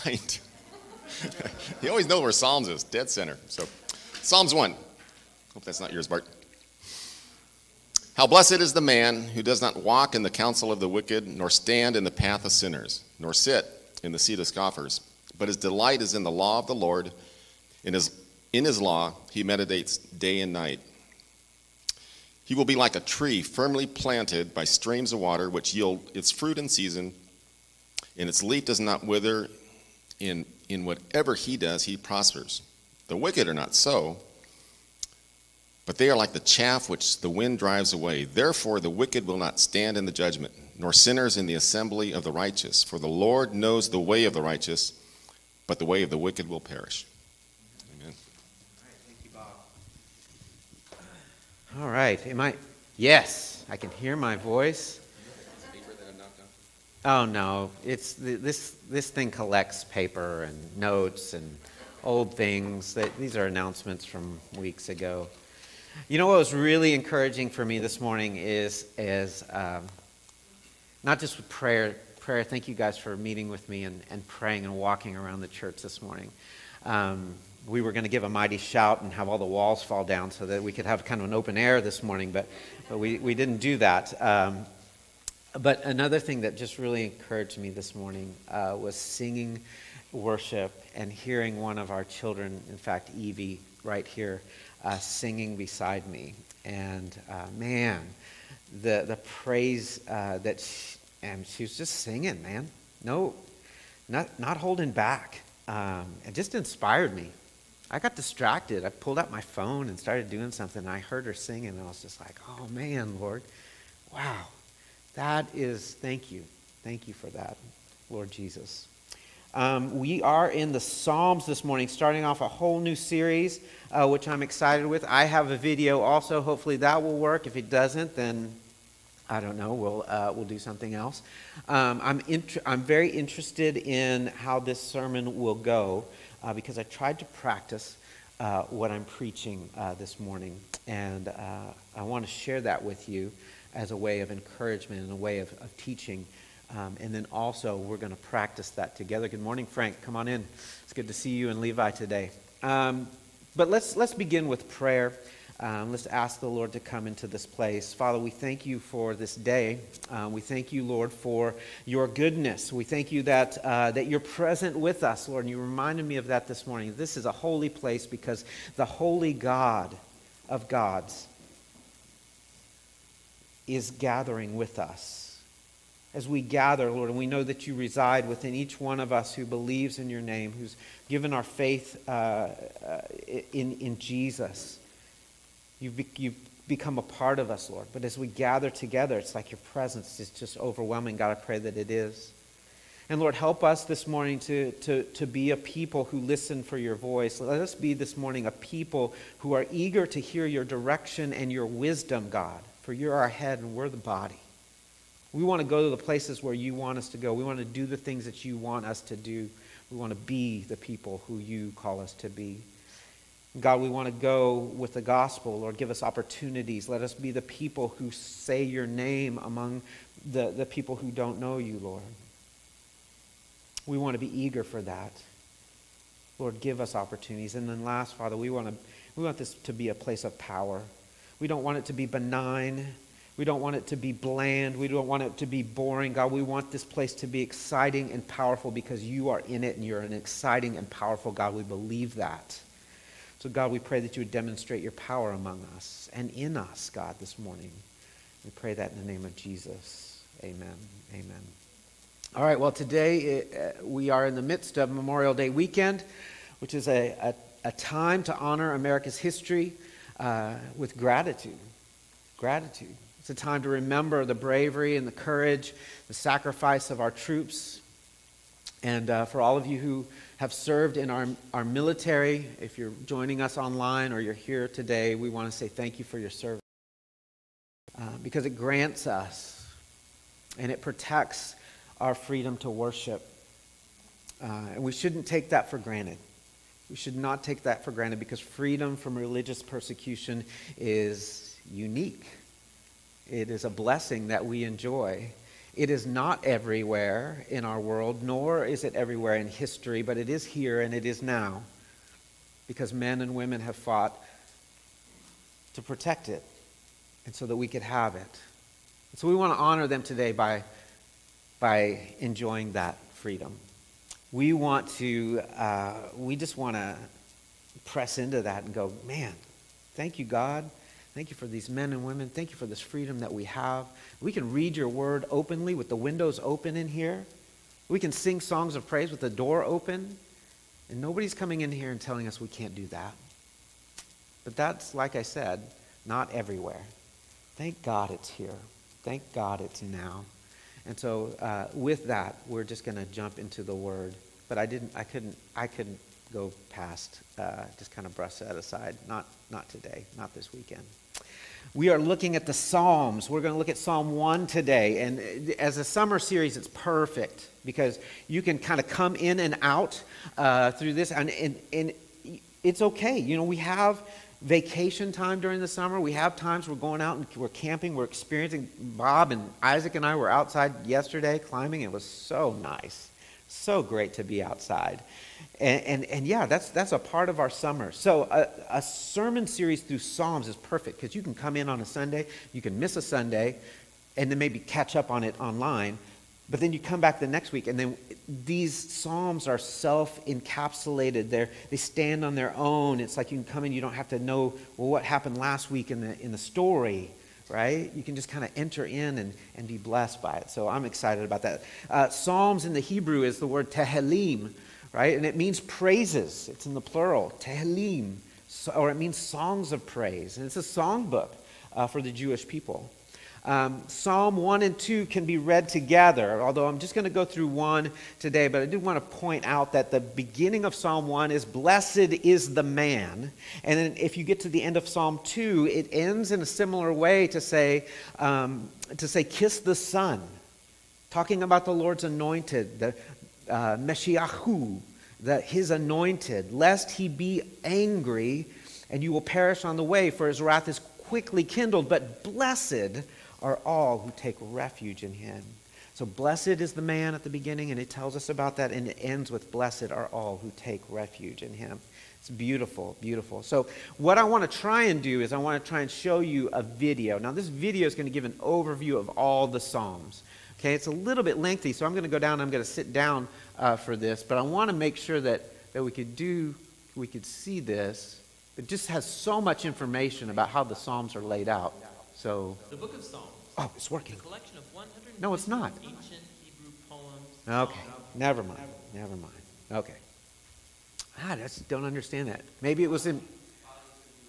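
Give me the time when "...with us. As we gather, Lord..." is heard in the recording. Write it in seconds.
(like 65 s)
174 s.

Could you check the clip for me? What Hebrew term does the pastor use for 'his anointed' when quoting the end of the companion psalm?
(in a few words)
Meshiachu.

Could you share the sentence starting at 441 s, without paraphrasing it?
But blessed are all who take refuge in him.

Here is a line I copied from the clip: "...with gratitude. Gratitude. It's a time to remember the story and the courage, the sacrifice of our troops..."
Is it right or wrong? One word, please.
wrong.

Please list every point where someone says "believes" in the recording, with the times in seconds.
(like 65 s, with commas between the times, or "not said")
179 s, 241 s.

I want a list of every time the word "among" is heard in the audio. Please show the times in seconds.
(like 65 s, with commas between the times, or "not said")
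219 s, 245 s.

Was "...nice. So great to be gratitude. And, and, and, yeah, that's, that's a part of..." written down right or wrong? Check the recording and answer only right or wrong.
wrong.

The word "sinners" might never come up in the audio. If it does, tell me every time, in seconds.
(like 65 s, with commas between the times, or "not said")
12 s, 40 s.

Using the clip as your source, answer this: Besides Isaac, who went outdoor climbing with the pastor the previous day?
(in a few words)
Bob.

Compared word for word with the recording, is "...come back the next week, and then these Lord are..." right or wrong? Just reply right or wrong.
wrong.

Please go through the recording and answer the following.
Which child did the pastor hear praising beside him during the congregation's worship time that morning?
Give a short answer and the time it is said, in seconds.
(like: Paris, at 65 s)
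Evie, at 93 s.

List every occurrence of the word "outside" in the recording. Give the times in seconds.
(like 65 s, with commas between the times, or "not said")
370 s, 374 s.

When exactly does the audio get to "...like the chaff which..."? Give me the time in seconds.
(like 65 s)
36 s.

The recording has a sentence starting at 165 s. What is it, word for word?
And you reminded me of that this morning.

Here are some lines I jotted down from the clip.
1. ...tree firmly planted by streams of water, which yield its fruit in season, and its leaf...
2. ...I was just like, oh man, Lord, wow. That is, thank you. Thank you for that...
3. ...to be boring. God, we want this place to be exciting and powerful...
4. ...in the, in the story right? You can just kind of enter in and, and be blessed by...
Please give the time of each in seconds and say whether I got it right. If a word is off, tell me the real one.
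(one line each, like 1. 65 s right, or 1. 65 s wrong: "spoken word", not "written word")
1. 23 s right
2. 111 s right
3. 235 s right
4. 395 s right.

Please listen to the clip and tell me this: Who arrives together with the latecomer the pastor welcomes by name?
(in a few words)
Levi.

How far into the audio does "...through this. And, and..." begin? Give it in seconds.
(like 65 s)
360 s.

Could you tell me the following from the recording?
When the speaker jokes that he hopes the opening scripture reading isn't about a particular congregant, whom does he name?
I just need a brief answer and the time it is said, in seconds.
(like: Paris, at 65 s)
Bart, at 6 s.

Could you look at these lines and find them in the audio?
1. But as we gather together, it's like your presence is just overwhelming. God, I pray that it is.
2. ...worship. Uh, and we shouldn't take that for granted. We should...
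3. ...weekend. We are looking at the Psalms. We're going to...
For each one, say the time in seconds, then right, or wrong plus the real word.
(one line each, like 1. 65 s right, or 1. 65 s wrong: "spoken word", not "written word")
1. 187 s right
2. 282 s right
3. 350 s right.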